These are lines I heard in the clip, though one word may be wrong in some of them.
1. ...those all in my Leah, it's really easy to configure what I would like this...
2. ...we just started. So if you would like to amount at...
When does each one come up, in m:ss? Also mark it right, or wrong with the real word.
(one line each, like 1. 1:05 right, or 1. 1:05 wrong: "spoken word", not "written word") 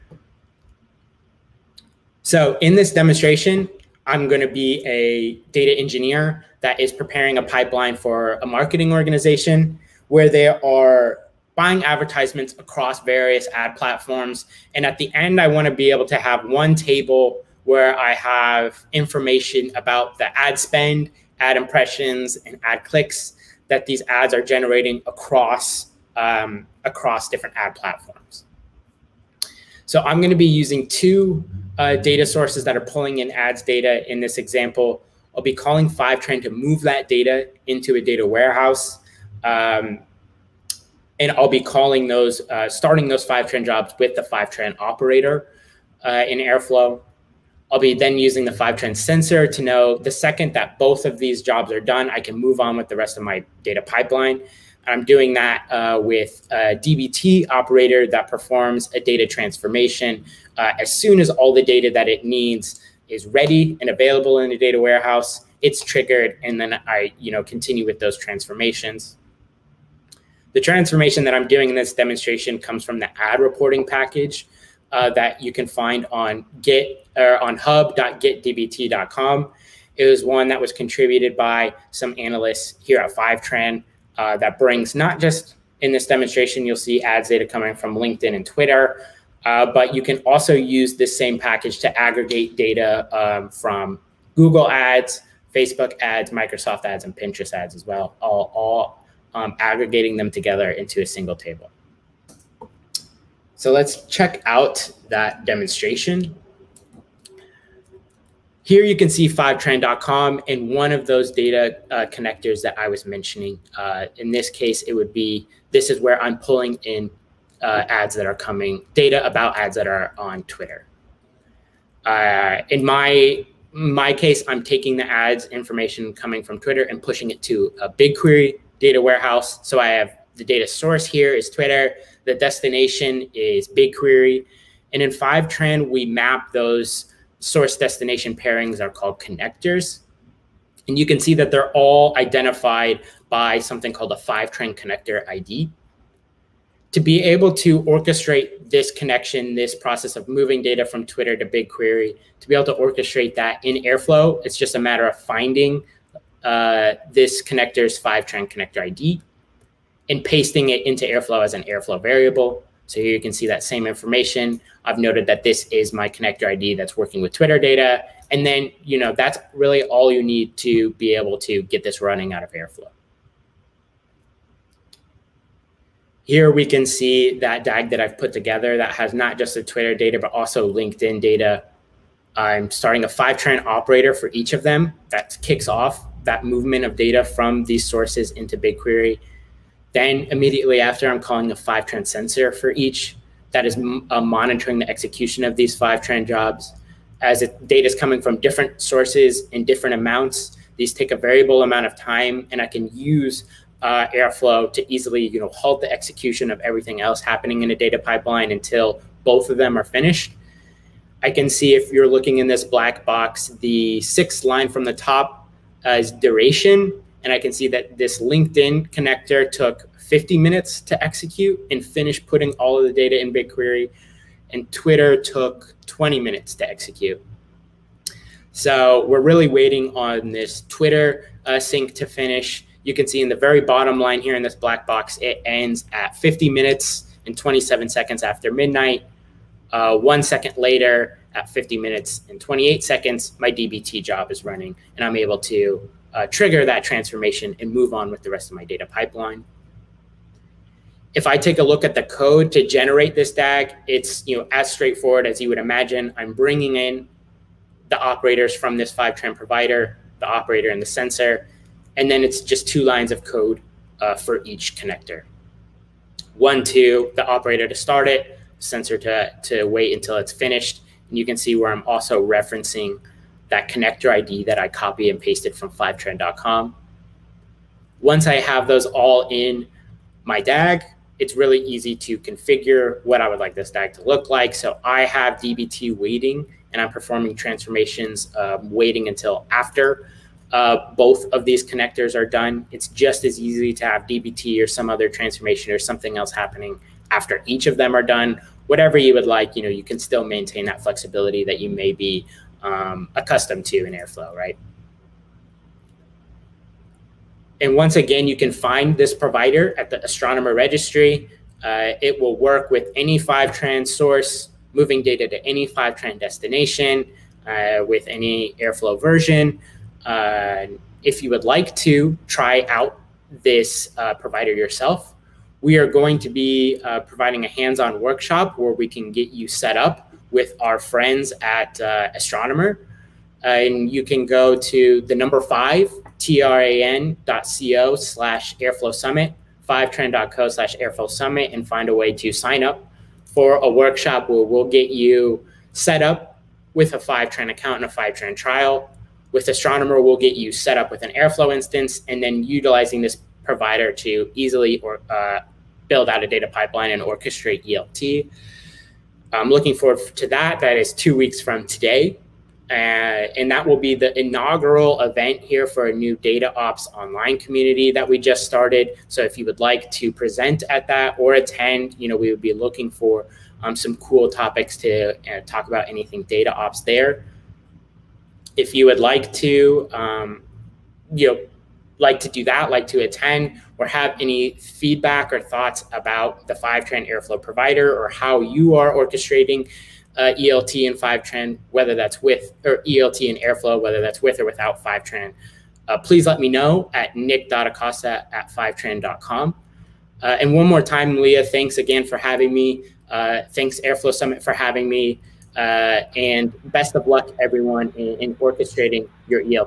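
1. 4:38 wrong: "DAG", not "Leah"
2. 6:08 wrong: "present", not "amount".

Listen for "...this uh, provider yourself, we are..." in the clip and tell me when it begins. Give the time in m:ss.
5:23.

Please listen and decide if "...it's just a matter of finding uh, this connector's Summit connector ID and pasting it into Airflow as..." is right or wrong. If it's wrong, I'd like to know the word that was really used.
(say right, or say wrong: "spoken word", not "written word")
wrong: "Fivetran", not "Summit".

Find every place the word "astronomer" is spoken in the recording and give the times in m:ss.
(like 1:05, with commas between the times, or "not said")
5:10, 5:32, 5:49.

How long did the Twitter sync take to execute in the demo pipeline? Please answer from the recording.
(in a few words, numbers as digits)
20 minutes.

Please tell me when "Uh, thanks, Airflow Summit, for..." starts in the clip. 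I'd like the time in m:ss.
6:43.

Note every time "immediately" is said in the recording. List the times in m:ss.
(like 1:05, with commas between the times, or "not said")
3:10.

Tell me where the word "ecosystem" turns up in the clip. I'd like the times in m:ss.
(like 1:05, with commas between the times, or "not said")
not said.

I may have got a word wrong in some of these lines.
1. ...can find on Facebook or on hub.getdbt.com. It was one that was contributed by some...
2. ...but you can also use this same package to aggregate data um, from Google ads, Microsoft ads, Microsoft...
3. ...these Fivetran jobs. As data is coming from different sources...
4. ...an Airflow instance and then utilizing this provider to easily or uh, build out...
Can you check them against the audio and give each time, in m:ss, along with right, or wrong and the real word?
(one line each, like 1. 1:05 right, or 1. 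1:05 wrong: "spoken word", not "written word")
1. 1:15 wrong: "Git", not "Facebook"
2. 1:29 wrong: "Facebook", not "Microsoft"
3. 3:15 right
4. 5:51 right.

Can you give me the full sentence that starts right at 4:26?
One to the operator to start it, sensor to, to wait until it's finished.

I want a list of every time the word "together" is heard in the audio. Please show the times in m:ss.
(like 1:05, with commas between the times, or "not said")
1:40, 2:58.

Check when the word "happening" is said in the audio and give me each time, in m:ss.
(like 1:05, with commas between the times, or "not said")
3:27, 4:56.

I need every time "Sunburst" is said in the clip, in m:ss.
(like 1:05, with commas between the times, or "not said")
not said.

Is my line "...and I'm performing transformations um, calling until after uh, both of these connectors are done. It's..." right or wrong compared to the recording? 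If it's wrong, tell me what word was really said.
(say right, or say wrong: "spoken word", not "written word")
wrong: "waiting", not "calling".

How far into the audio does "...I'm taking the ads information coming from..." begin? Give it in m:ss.
2:04.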